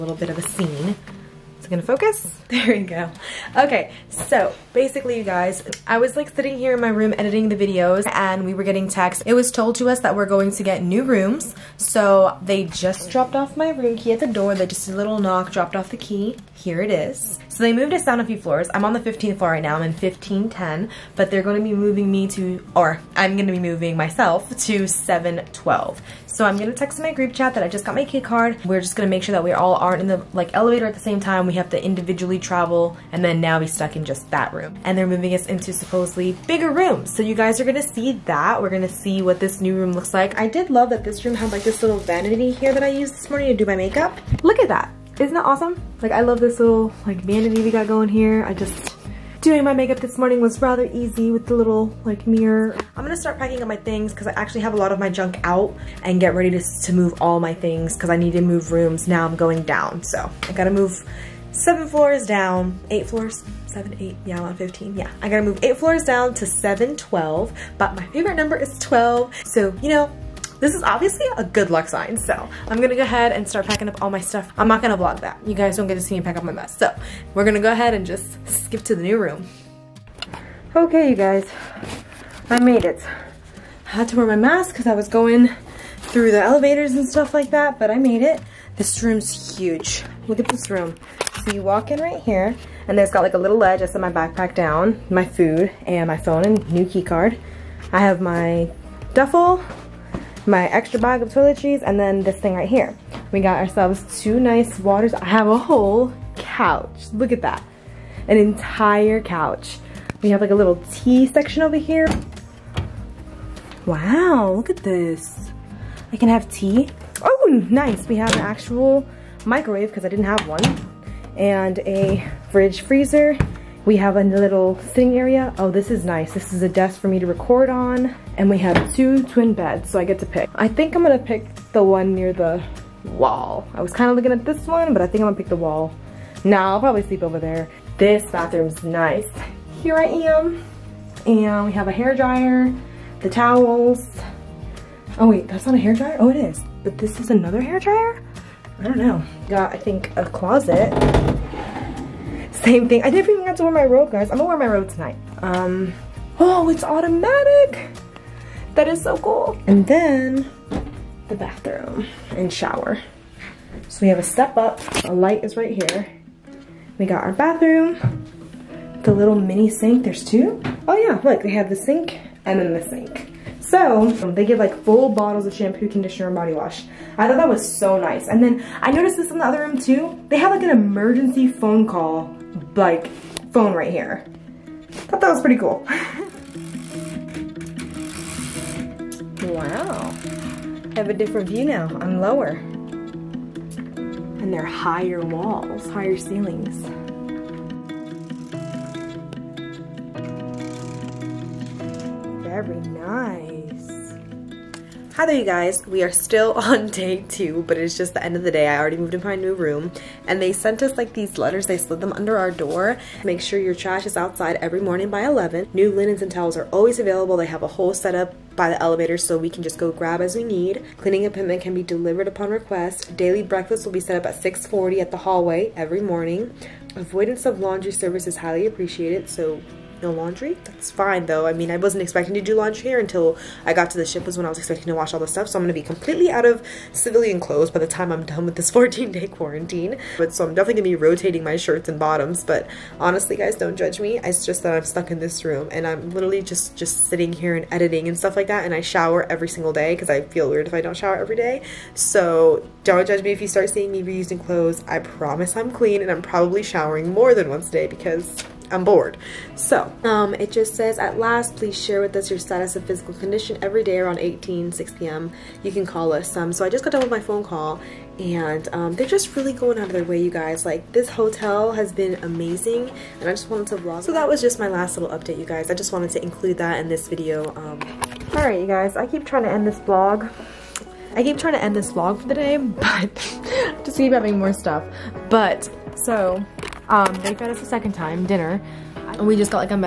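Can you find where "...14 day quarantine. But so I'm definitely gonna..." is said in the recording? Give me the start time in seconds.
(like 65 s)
238 s.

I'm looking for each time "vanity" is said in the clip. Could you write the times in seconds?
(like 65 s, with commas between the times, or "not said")
41 s, 47 s.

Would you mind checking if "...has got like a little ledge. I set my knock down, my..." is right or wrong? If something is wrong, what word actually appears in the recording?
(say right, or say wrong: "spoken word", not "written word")
wrong: "backpack", not "knock".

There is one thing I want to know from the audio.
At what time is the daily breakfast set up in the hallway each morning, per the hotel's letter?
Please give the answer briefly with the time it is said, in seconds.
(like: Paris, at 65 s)
6:40, at 224 s.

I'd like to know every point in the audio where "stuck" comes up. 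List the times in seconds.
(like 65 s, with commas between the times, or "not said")
33 s, 244 s.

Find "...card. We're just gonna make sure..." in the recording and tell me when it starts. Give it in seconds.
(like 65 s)
28 s.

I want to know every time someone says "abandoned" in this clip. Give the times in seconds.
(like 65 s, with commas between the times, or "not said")
not said.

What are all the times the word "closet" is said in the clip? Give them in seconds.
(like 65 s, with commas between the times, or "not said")
150 s.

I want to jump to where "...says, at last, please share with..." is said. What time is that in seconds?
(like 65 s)
260 s.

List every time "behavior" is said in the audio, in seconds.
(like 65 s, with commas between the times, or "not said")
not said.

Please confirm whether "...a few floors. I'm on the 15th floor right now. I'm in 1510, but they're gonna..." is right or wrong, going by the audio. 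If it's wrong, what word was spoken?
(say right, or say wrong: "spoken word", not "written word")
right.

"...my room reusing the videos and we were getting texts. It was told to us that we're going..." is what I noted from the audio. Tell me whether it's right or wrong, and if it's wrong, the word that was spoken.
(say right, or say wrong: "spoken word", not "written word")
wrong: "editing", not "reusing".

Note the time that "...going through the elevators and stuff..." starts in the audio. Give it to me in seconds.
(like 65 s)
85 s.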